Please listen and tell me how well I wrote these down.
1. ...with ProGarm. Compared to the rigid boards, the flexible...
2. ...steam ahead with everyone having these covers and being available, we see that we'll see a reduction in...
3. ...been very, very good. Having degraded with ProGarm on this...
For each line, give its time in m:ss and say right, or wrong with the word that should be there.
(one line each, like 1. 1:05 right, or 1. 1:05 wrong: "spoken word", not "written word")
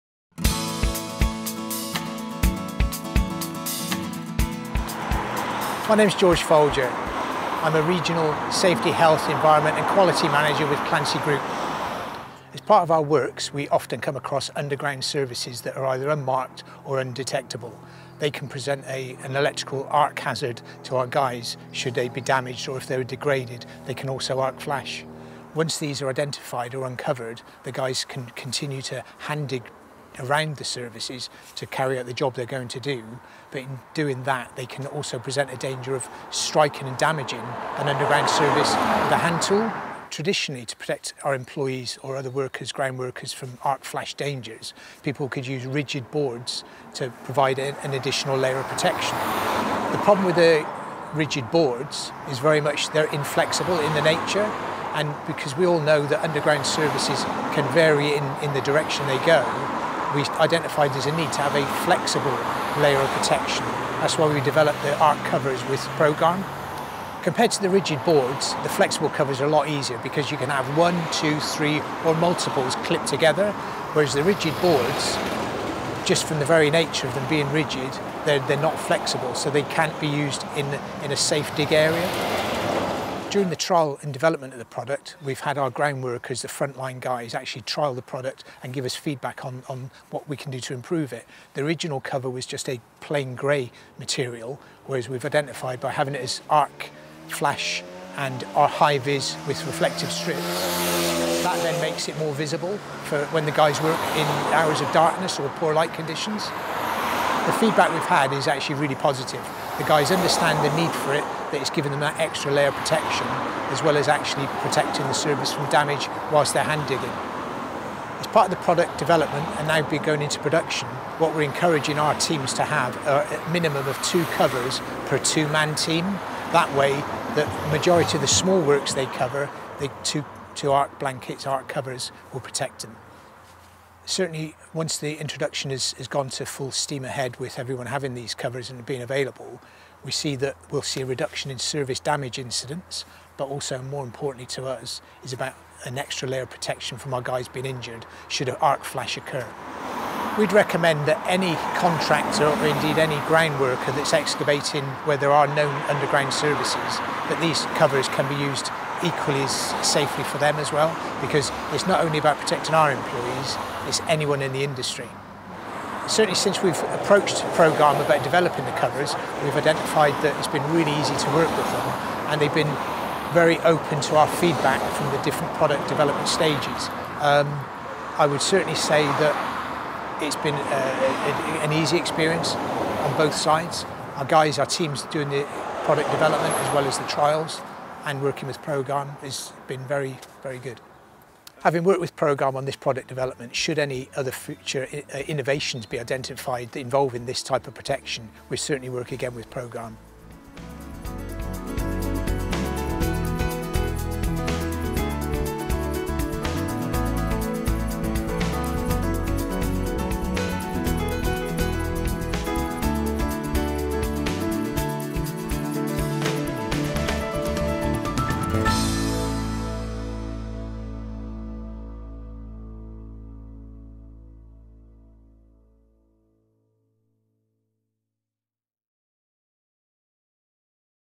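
1. 1:05 right
2. 2:16 right
3. 3:09 wrong: "worked", not "degraded".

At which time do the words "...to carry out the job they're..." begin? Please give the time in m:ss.
0:31.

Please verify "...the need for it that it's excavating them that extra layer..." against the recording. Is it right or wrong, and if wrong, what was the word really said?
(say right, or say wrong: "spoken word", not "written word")
wrong: "giving", not "excavating".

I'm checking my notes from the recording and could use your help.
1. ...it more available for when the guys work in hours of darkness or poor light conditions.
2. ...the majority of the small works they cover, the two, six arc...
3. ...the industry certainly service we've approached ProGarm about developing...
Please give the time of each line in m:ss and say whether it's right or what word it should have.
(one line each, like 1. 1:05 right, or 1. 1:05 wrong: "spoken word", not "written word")
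1. 1:42 wrong: "visible", not "available"
2. 2:07 wrong: "two", not "six"
3. 2:44 wrong: "since", not "service".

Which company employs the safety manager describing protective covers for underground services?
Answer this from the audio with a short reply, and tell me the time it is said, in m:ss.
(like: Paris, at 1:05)
Clancy Group, at 0:10.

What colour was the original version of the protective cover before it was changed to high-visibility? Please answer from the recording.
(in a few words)
Grey.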